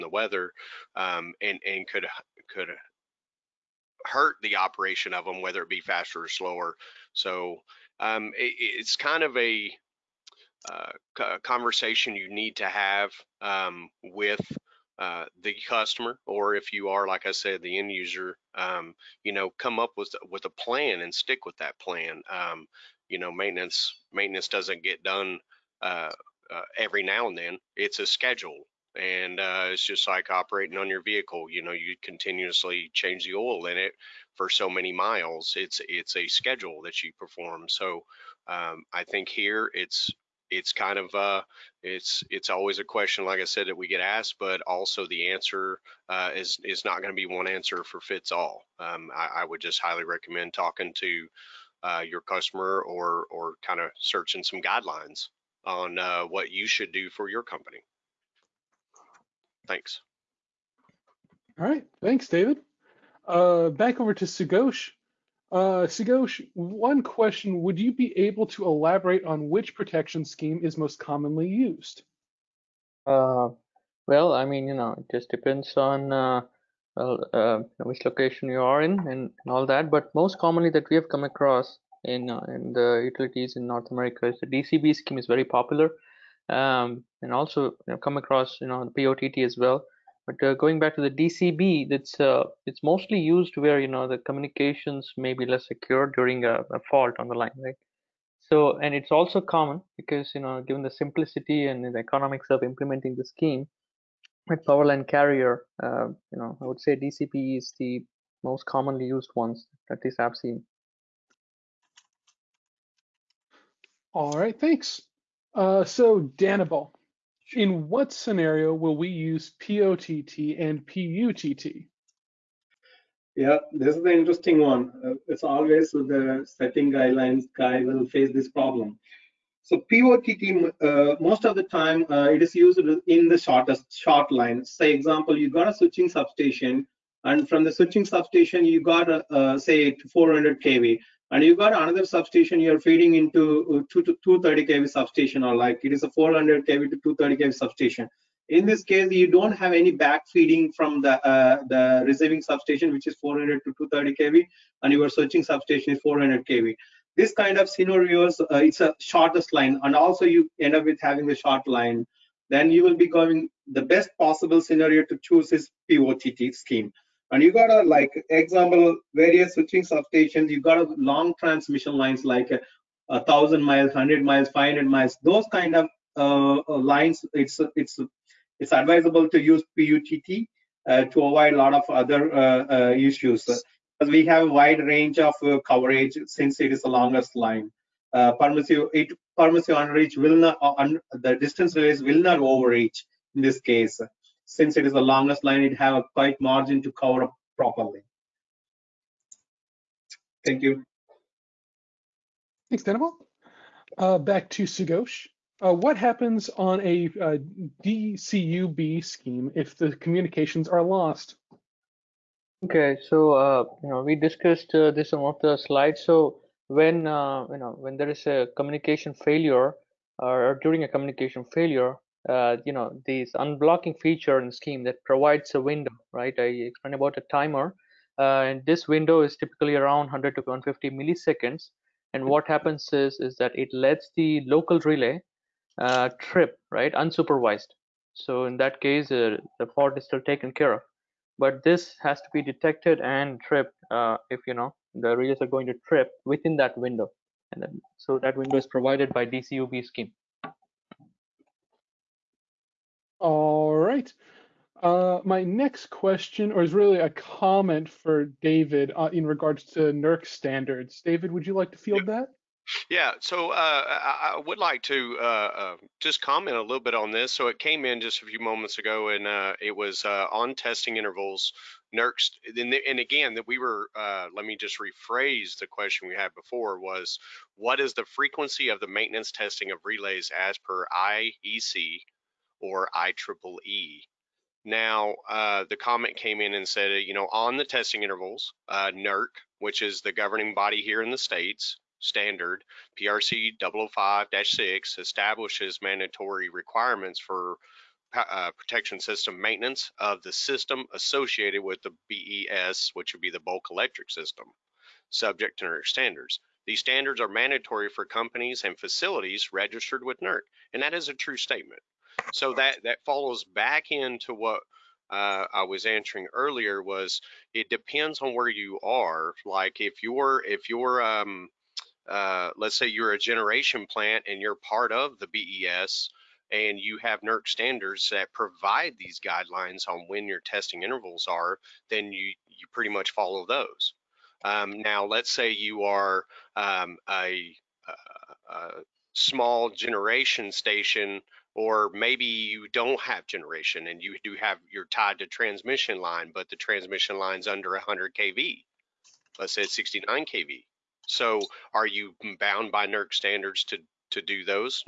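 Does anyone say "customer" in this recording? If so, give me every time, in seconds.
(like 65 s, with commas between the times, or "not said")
15 s, 52 s.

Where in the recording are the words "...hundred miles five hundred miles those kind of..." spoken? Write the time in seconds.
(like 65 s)
173 s.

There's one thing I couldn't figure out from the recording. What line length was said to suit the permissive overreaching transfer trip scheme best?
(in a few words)
shortest short line.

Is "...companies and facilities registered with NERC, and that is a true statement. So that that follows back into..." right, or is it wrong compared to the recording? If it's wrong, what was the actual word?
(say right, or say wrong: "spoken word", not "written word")
right.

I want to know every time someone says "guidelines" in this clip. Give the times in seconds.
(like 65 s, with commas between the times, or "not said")
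54 s, 126 s, 329 s.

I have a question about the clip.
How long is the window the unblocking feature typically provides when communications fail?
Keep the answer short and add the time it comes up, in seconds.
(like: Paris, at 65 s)
100 to 150 milliseconds, at 230 s.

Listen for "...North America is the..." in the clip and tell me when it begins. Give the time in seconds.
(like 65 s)
83 s.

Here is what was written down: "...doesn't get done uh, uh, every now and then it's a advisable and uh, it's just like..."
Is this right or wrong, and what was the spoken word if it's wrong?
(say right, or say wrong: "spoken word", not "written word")
wrong: "schedule", not "advisable".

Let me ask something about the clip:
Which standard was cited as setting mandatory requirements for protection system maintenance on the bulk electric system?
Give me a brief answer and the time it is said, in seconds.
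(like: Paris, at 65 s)
PRC 005-6, at 293 s.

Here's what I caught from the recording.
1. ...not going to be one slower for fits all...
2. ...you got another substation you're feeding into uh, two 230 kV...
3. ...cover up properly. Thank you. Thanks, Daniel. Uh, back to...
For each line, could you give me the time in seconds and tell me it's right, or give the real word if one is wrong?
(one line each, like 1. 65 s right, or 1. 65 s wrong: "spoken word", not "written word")
1. 46 s wrong: "answer", not "slower"
2. 141 s right
3. 196 s right.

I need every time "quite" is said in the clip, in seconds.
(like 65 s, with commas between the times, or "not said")
196 s.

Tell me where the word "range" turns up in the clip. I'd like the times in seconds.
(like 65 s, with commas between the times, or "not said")
184 s, 191 s.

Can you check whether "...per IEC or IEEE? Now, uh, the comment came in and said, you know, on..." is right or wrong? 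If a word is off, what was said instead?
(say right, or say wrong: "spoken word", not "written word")
right.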